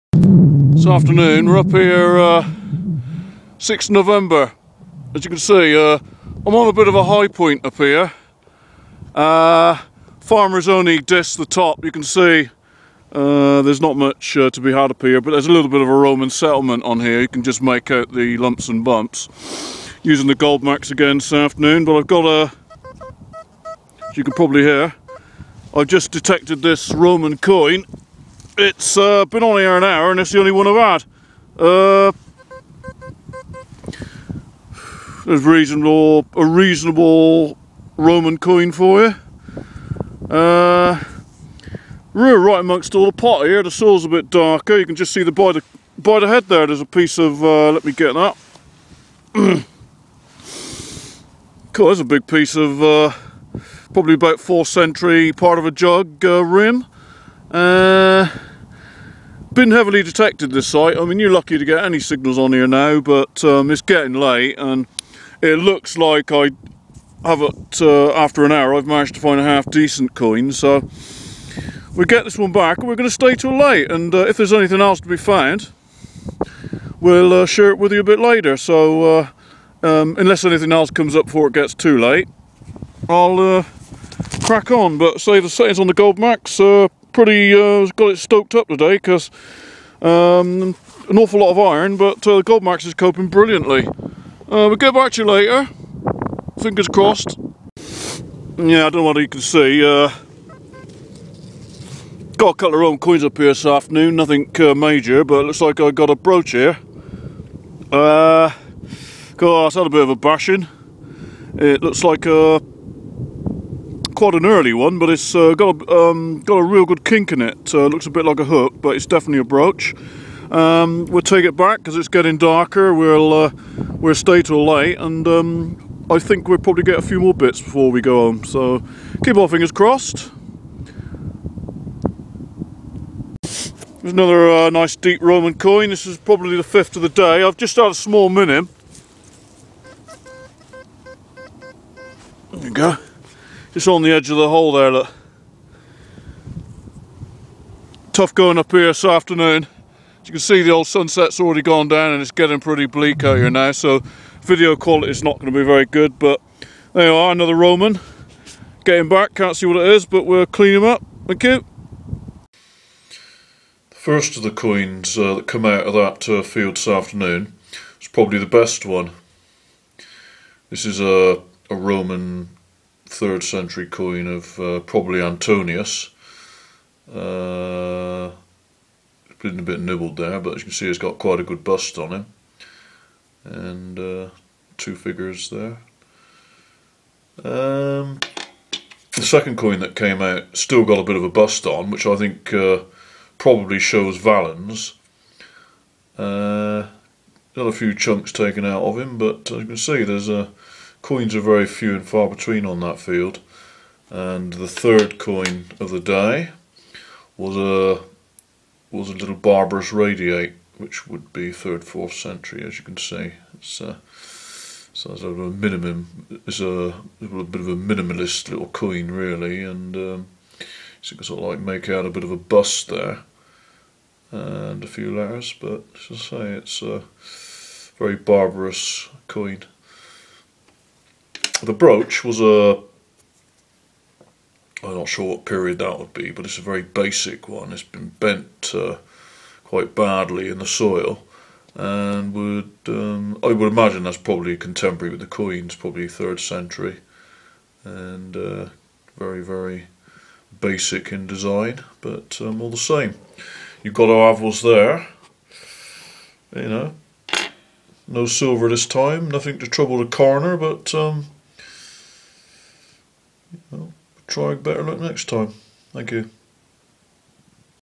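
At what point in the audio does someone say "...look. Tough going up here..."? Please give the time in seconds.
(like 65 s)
144 s.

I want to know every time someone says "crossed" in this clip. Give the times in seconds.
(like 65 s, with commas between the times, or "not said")
96 s, 129 s.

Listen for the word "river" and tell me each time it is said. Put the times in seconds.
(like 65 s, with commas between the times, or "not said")
not said.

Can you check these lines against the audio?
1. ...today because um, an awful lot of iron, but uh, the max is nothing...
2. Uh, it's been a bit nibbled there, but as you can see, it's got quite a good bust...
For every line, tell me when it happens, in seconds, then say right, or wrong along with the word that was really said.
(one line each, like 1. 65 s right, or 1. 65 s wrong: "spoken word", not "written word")
1. 88 s wrong: "coping", not "nothing"
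2. 177 s right.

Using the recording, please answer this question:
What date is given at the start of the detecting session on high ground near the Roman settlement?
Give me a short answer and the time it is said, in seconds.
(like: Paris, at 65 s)
6 November, at 3 s.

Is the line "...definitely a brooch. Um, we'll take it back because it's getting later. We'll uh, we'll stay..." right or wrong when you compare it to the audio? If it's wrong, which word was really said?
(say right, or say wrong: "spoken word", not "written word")
wrong: "darker", not "later".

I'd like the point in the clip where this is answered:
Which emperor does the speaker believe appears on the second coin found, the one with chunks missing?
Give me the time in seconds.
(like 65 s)
194 s.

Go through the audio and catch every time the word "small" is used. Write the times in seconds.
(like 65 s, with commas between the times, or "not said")
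137 s.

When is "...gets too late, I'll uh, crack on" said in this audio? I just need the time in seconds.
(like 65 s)
81 s.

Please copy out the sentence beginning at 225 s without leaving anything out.
But as I say, it's a very barbarous coin.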